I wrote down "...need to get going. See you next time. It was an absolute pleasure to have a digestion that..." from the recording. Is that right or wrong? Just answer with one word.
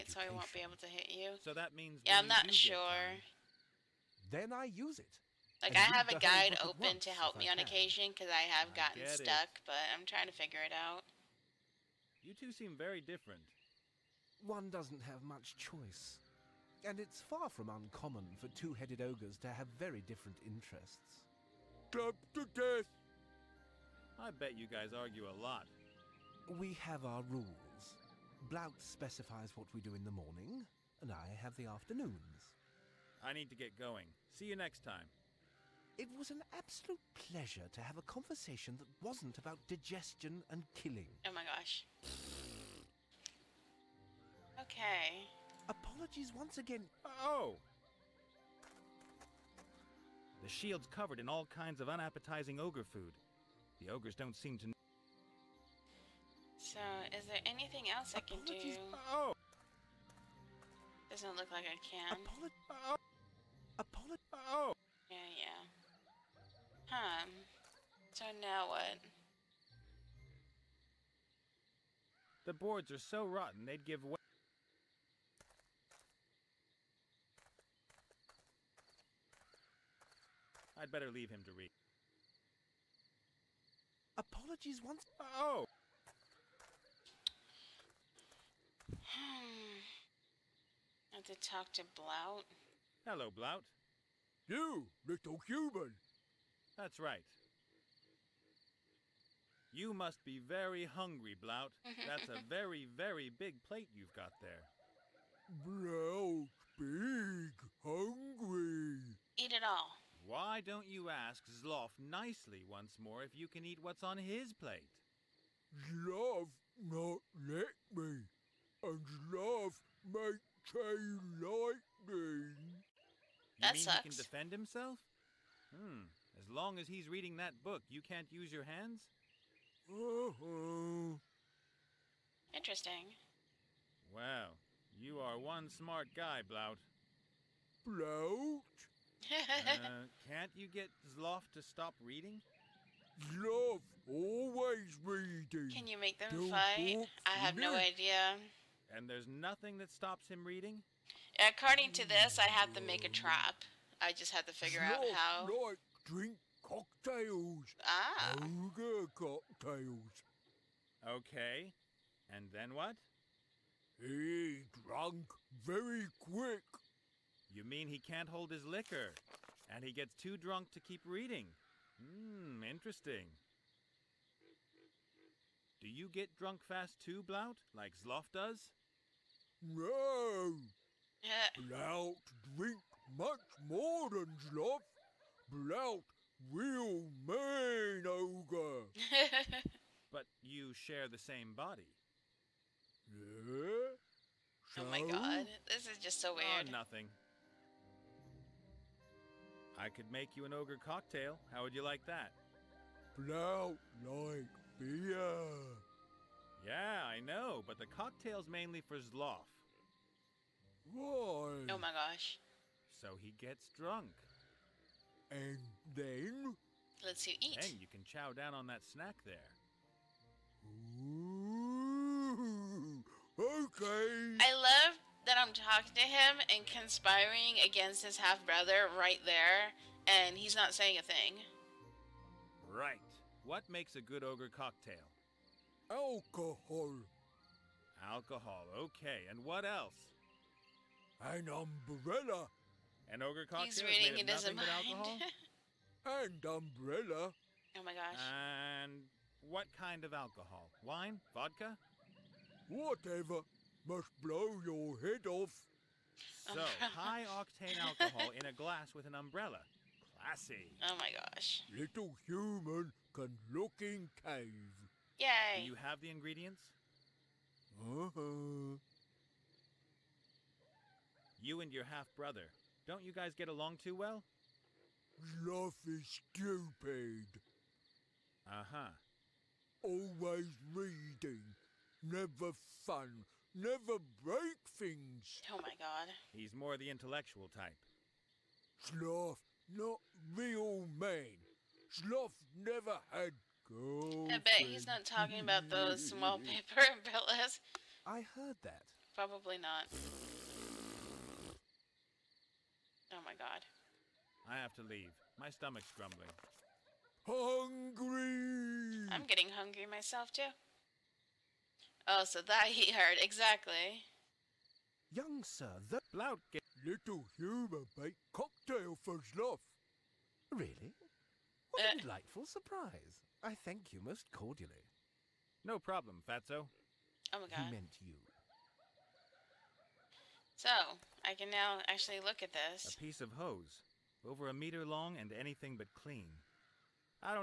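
wrong.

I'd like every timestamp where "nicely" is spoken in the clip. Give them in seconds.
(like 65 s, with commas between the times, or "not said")
111 s.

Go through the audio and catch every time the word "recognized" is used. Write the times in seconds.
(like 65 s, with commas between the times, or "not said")
not said.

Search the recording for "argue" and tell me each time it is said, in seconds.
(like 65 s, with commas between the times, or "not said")
24 s.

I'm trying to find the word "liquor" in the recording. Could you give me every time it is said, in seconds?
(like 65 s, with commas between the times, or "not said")
168 s.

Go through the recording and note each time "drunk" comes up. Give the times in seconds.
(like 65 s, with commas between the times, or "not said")
170 s, 176 s, 213 s.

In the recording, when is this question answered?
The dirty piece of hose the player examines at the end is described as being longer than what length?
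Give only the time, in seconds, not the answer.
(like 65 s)
334 s.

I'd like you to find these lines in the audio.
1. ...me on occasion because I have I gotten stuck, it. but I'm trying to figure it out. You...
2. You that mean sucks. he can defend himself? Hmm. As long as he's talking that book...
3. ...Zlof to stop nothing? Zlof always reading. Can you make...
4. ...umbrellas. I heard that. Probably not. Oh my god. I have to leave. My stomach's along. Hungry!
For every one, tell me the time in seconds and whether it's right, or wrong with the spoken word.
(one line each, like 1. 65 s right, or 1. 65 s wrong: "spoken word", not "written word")
1. 7 s right
2. 122 s wrong: "reading", not "talking"
3. 141 s wrong: "reading", not "nothing"
4. 296 s wrong: "grumbling", not "along".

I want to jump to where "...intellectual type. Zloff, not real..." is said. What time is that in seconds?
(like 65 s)
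286 s.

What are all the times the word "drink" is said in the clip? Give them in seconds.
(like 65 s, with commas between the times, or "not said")
156 s, 182 s.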